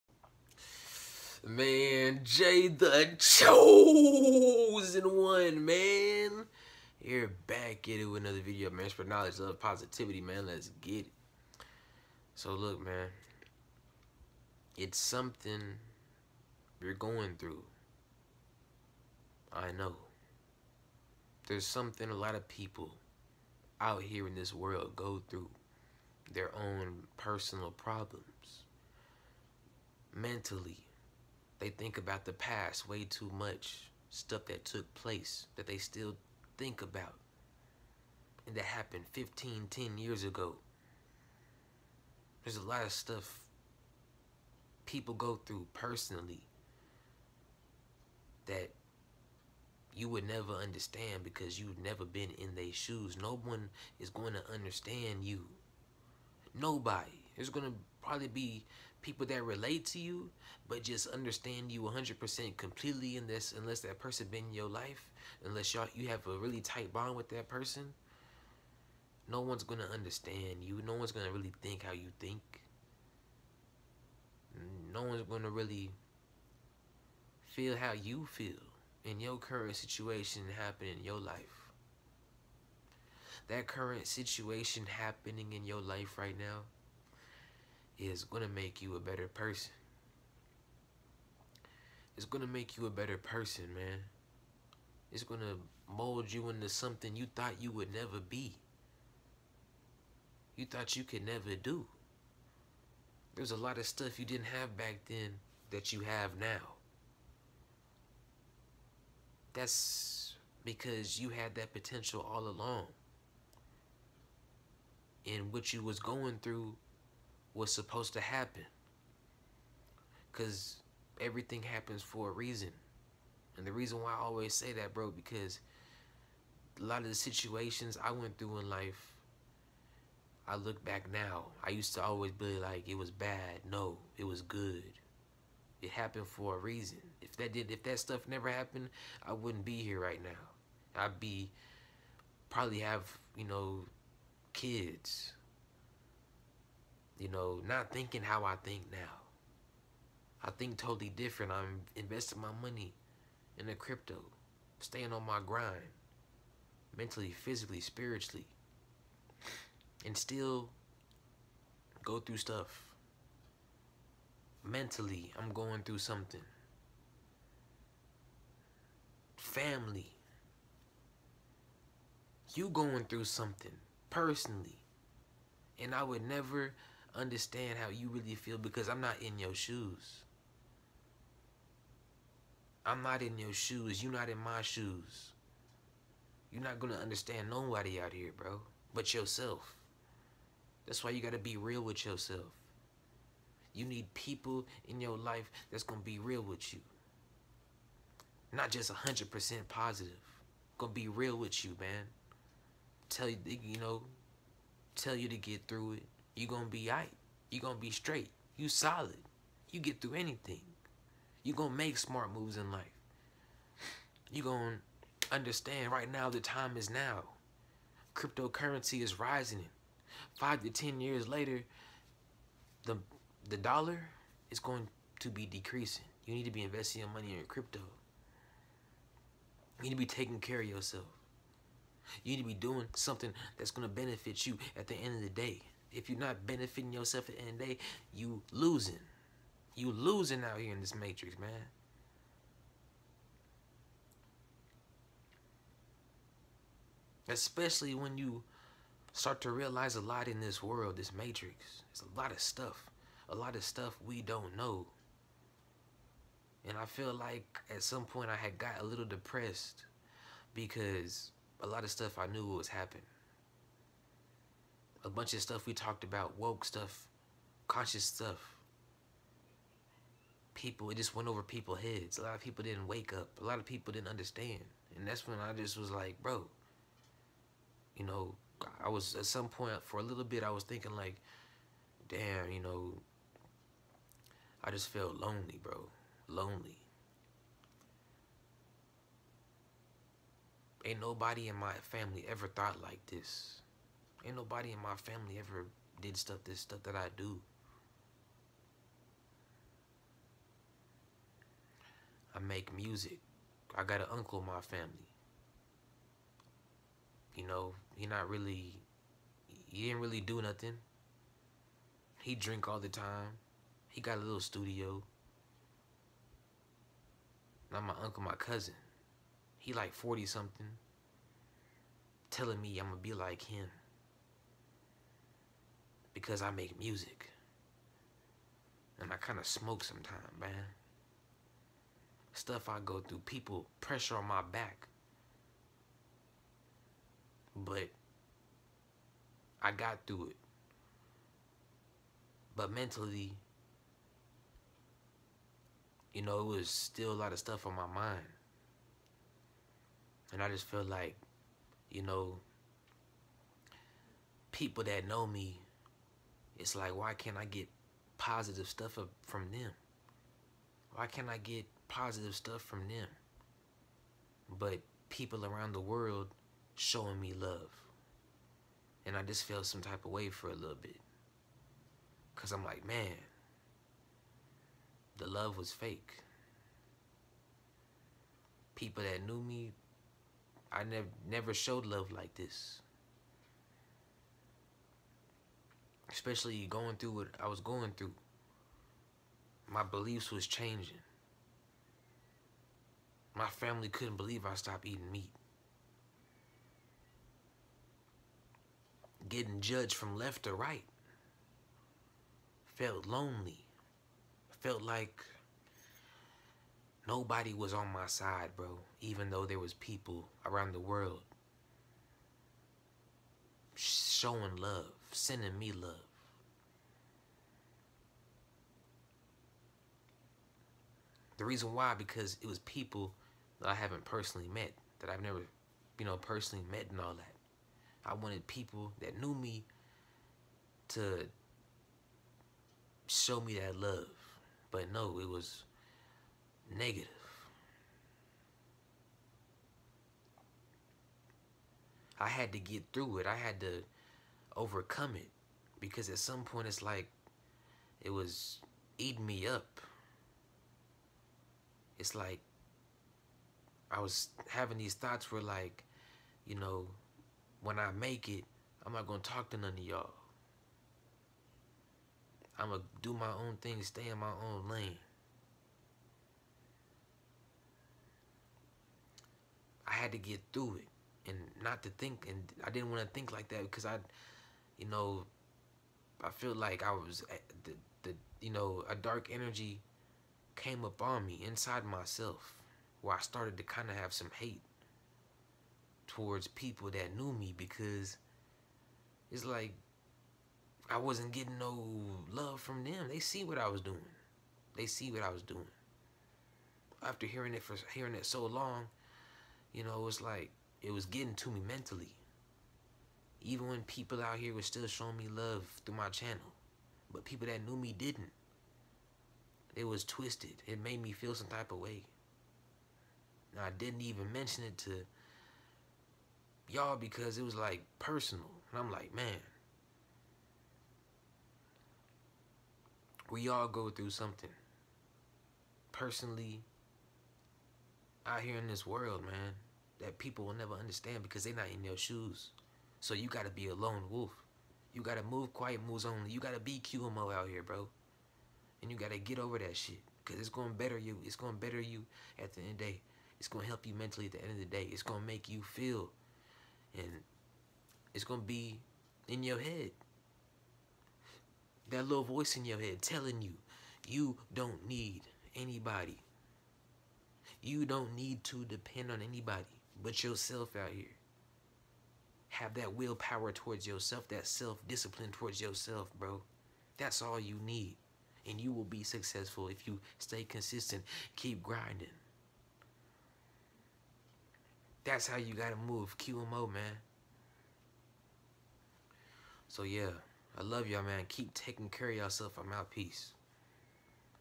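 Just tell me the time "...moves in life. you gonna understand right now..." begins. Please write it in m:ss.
3:32.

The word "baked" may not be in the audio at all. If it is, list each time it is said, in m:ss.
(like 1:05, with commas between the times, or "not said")
not said.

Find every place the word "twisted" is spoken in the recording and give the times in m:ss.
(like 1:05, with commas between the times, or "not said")
8:30.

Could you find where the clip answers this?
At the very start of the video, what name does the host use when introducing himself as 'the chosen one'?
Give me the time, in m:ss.
0:02.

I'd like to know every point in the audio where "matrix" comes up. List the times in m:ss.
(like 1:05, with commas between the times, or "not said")
4:00, 4:11.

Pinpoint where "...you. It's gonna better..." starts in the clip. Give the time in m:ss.
9:00.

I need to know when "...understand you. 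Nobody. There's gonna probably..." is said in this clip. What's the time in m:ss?
0:54.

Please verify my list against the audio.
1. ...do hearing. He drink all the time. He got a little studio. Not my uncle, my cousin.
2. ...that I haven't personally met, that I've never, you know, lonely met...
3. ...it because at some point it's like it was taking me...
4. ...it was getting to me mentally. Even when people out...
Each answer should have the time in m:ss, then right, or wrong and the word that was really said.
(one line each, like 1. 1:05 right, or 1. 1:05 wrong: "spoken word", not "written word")
1. 5:10 wrong: "nothing", not "hearing"
2. 7:03 wrong: "personally", not "lonely"
3. 7:25 wrong: "eating", not "taking"
4. 8:20 right.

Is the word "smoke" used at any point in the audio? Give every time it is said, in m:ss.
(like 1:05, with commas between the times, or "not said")
5:29.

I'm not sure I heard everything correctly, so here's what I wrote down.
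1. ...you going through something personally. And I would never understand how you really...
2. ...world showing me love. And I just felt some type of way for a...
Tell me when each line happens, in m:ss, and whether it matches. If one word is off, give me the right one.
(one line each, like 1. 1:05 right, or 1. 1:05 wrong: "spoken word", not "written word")
1. 2:52 right
2. 6:05 right.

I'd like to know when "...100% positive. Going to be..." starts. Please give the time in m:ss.
3:18.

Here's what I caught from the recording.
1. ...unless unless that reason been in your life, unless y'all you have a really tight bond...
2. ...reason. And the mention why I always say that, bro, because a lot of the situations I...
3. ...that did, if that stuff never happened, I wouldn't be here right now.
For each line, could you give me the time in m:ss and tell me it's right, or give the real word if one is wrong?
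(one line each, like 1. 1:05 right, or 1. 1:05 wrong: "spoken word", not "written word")
1. 1:03 wrong: "person", not "reason"
2. 2:02 wrong: "reason", not "mention"
3. 2:17 right.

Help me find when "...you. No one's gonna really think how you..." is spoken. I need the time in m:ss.
1:10.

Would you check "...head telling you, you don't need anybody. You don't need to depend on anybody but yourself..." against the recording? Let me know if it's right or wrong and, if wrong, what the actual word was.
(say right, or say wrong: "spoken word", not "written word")
right.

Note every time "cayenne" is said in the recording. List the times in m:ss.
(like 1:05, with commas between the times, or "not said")
not said.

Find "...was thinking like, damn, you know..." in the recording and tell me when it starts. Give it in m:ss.
4:40.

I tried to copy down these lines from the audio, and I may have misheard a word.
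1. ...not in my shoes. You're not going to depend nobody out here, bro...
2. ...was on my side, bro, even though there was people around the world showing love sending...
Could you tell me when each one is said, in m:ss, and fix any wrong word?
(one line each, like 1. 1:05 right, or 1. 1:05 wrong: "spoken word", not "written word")
1. 3:04 wrong: "understand", not "depend"
2. 6:47 right.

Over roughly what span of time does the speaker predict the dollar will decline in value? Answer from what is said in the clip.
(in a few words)
5 to 10 years.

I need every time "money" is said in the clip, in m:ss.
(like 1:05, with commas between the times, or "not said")
2:32, 3:47.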